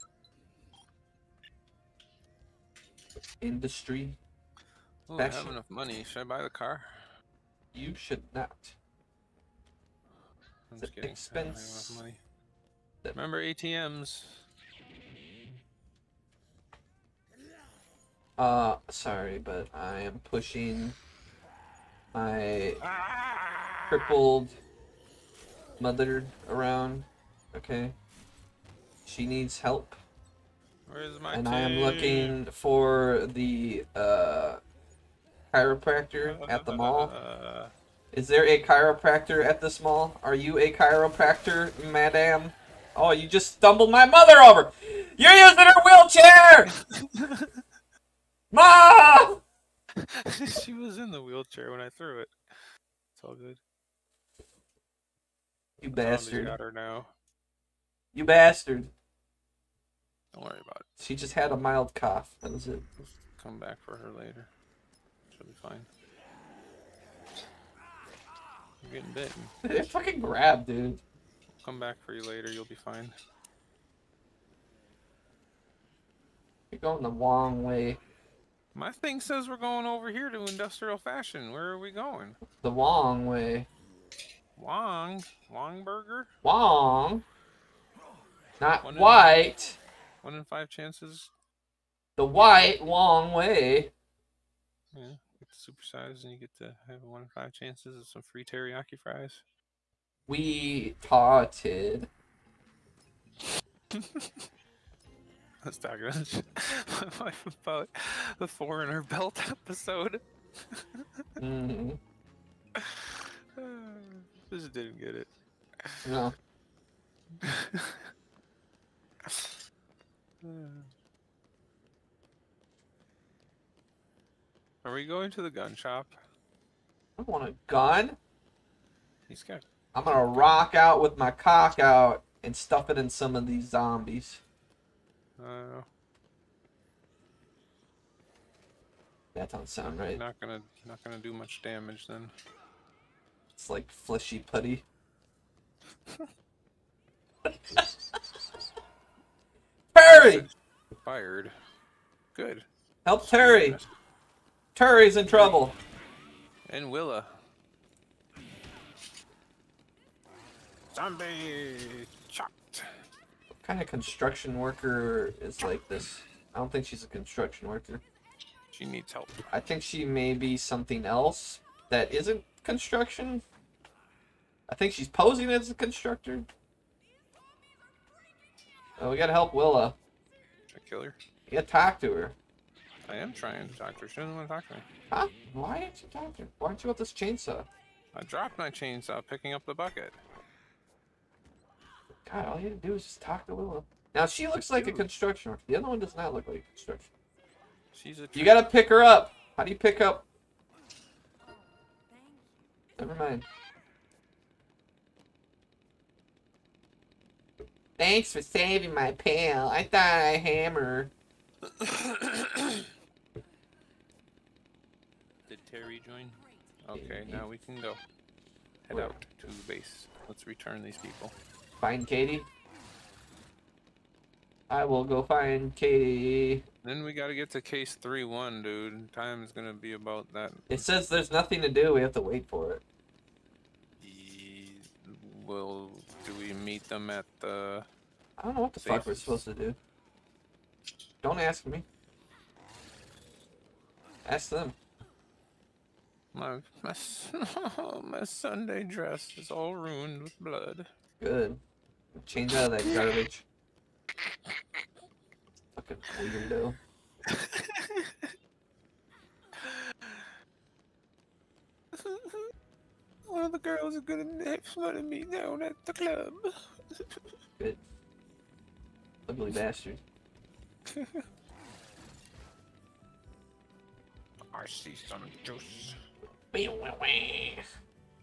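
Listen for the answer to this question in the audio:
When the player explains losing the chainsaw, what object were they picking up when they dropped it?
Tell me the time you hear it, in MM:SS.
03:09.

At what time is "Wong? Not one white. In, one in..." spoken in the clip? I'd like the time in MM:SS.
01:26.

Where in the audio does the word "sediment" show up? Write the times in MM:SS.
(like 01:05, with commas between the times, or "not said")
not said.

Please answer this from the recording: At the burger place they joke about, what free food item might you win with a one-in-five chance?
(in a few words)
Teriyaki fries.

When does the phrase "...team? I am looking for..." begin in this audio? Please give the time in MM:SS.
00:31.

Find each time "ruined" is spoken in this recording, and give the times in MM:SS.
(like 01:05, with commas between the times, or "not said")
04:09.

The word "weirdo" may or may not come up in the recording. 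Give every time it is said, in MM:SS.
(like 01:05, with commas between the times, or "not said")
04:16.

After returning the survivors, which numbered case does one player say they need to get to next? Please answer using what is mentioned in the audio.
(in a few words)
Case 3-1.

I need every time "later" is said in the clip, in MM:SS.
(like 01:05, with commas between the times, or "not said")
01:04, 01:12.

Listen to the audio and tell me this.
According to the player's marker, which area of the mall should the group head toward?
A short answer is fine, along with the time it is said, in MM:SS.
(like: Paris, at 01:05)
Industrial fashion, at 01:20.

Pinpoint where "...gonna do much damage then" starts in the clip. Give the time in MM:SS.
02:21.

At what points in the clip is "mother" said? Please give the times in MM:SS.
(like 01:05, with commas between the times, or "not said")
00:25, 00:44.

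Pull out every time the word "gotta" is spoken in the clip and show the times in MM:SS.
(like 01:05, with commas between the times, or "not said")
02:59, 03:18, 03:47.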